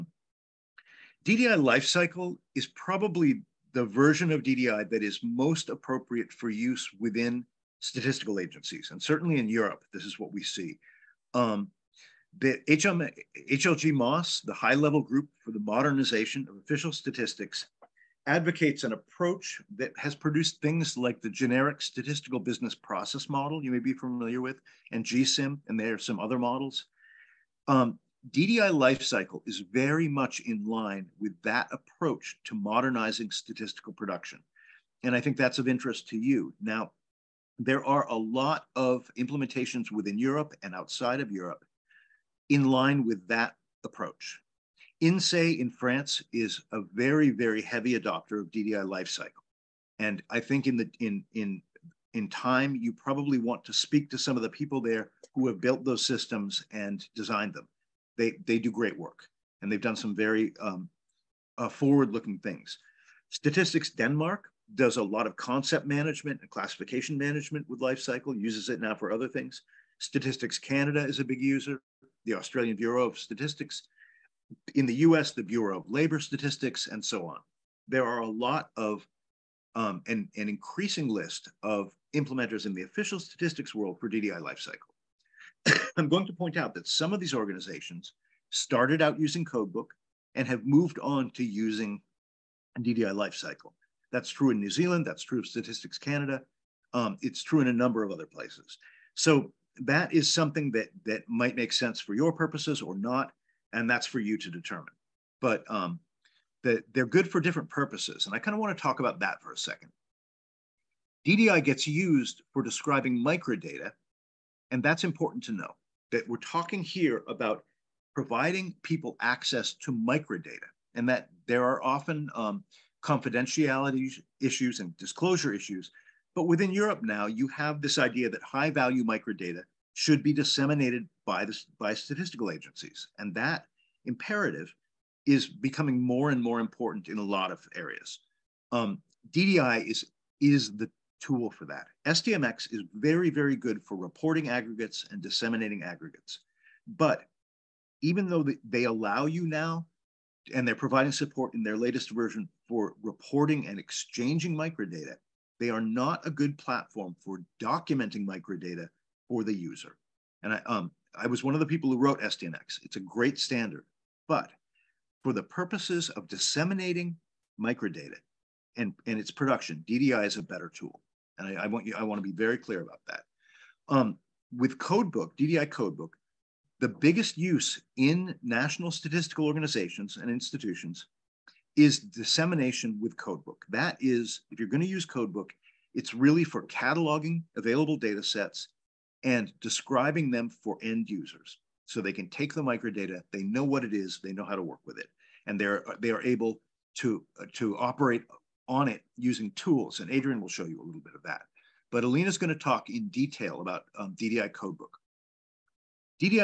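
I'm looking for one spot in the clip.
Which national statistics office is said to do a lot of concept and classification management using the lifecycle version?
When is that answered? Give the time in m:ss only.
1:03.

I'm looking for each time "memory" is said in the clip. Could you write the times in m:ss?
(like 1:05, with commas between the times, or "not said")
not said.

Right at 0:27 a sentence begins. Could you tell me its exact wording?
Um, DDI lifecycle is very much in line with that approach to modernizing statistical production.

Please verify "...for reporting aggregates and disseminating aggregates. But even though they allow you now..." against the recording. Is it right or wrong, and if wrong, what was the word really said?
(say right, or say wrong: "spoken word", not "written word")
right.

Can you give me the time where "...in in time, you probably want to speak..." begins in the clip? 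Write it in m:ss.
0:51.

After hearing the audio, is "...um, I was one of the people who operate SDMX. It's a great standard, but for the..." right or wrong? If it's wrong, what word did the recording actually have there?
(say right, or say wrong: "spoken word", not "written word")
wrong: "wrote", not "operate".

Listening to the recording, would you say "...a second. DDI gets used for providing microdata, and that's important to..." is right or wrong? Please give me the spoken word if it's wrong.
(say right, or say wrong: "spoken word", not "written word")
wrong: "describing", not "providing".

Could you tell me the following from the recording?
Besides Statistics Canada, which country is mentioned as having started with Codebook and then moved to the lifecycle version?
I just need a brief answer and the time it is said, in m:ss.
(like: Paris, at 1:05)
New Zealand, at 1:34.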